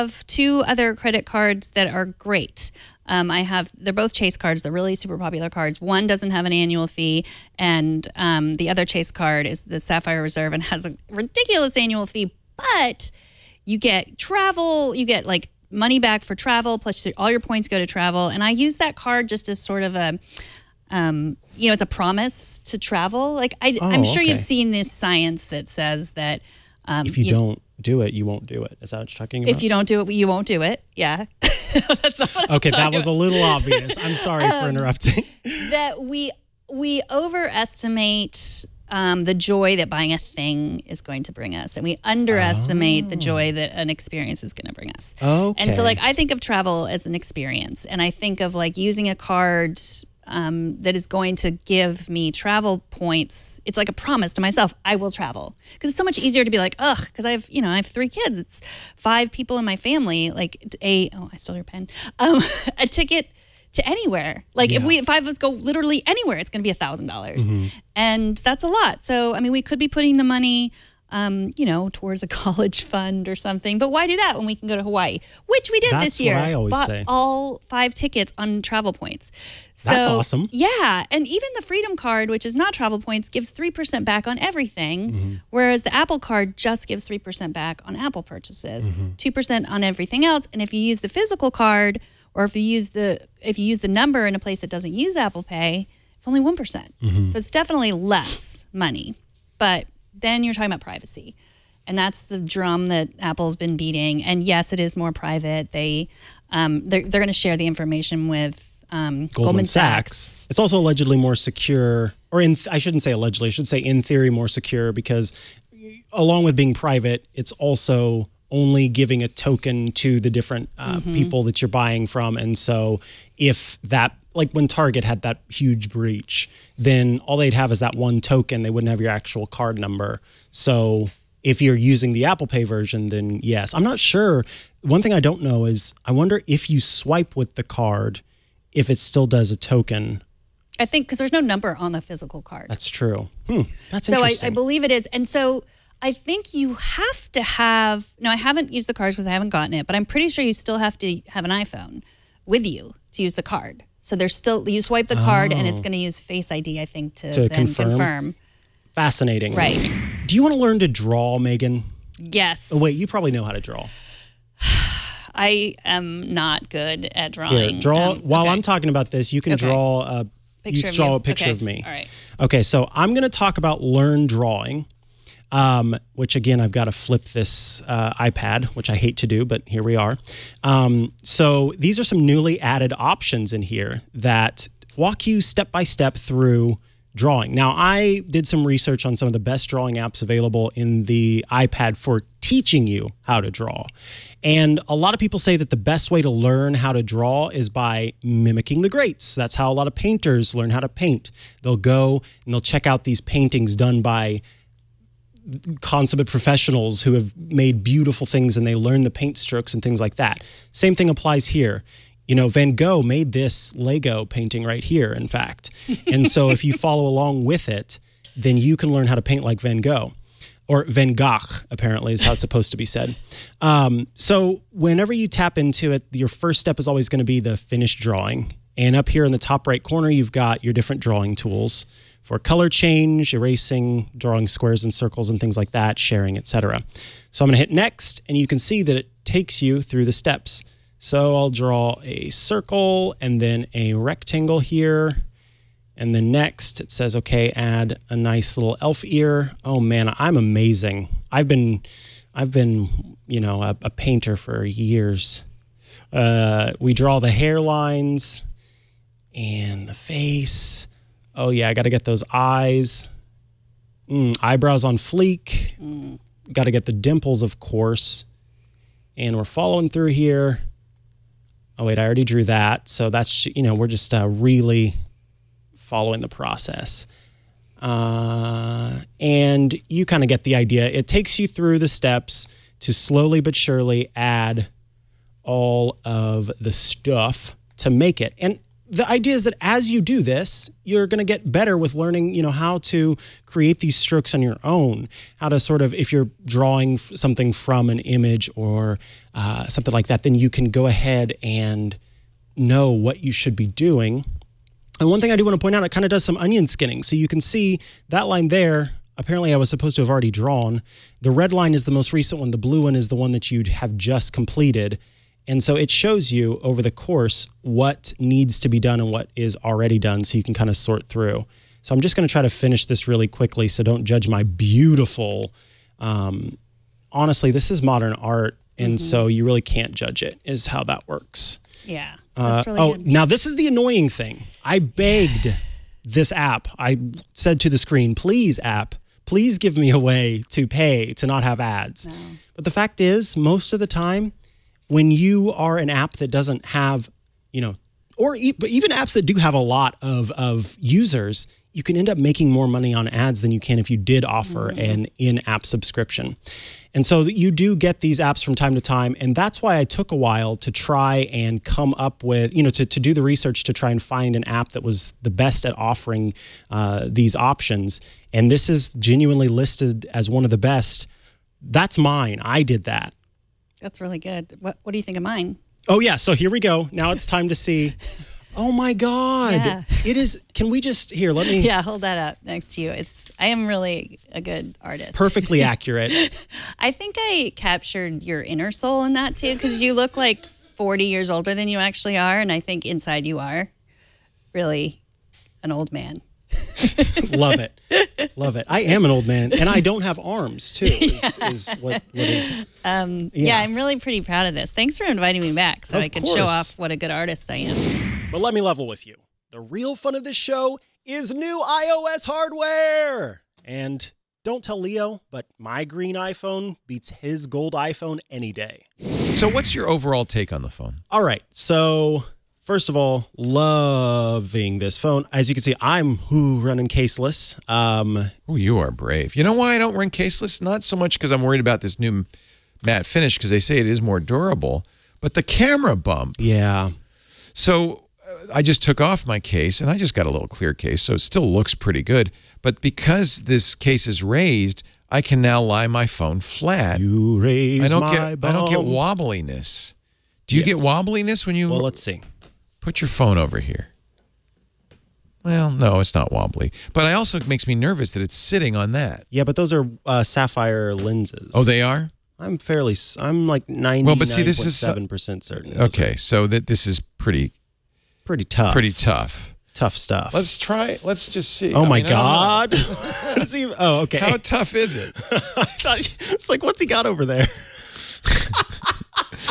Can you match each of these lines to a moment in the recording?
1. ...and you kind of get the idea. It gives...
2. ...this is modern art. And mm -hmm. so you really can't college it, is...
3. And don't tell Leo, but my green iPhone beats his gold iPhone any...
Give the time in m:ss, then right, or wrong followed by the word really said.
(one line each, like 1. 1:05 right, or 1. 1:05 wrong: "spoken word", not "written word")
1. 4:39 wrong: "takes", not "gives"
2. 5:27 wrong: "judge", not "college"
3. 6:53 right.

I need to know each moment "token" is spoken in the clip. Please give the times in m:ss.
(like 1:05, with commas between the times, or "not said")
1:59, 2:08, 2:19.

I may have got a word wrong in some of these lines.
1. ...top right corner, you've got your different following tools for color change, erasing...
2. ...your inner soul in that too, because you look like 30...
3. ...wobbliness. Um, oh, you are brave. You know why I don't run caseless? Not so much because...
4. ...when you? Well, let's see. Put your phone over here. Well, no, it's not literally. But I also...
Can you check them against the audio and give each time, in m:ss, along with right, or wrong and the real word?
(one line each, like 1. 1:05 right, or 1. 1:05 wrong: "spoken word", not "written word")
1. 3:49 wrong: "drawing", not "following"
2. 6:28 wrong: "40", not "30"
3. 7:06 wrong: "caseless", not "wobbliness"
4. 7:31 wrong: "wobbly", not "literally".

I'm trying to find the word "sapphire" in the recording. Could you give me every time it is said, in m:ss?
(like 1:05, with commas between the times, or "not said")
0:09, 7:40.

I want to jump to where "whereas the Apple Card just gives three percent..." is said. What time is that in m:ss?
1:25.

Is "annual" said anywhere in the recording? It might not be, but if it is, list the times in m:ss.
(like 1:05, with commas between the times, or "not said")
0:06, 0:11.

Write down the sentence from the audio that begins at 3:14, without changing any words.
And a lot of people say that the best way to learn how to draw is by mimicking the greats.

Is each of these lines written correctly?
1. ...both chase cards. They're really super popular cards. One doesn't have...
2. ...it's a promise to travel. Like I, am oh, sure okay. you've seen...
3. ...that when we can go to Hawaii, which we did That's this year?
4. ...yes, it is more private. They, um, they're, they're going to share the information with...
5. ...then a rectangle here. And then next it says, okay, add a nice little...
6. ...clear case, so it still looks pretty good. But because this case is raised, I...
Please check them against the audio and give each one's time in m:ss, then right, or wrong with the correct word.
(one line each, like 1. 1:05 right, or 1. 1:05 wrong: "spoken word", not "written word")
1. 0:03 right
2. 0:21 right
3. 1:14 right
4. 1:44 right
5. 4:03 right
6. 7:20 right.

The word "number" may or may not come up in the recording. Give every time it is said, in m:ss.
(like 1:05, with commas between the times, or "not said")
1:33, 2:09, 2:21.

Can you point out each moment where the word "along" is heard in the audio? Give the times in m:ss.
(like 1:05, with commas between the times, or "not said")
1:56, 3:37.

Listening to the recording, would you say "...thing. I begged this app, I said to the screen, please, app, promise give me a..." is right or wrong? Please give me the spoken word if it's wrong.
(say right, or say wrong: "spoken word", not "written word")
wrong: "please", not "promise".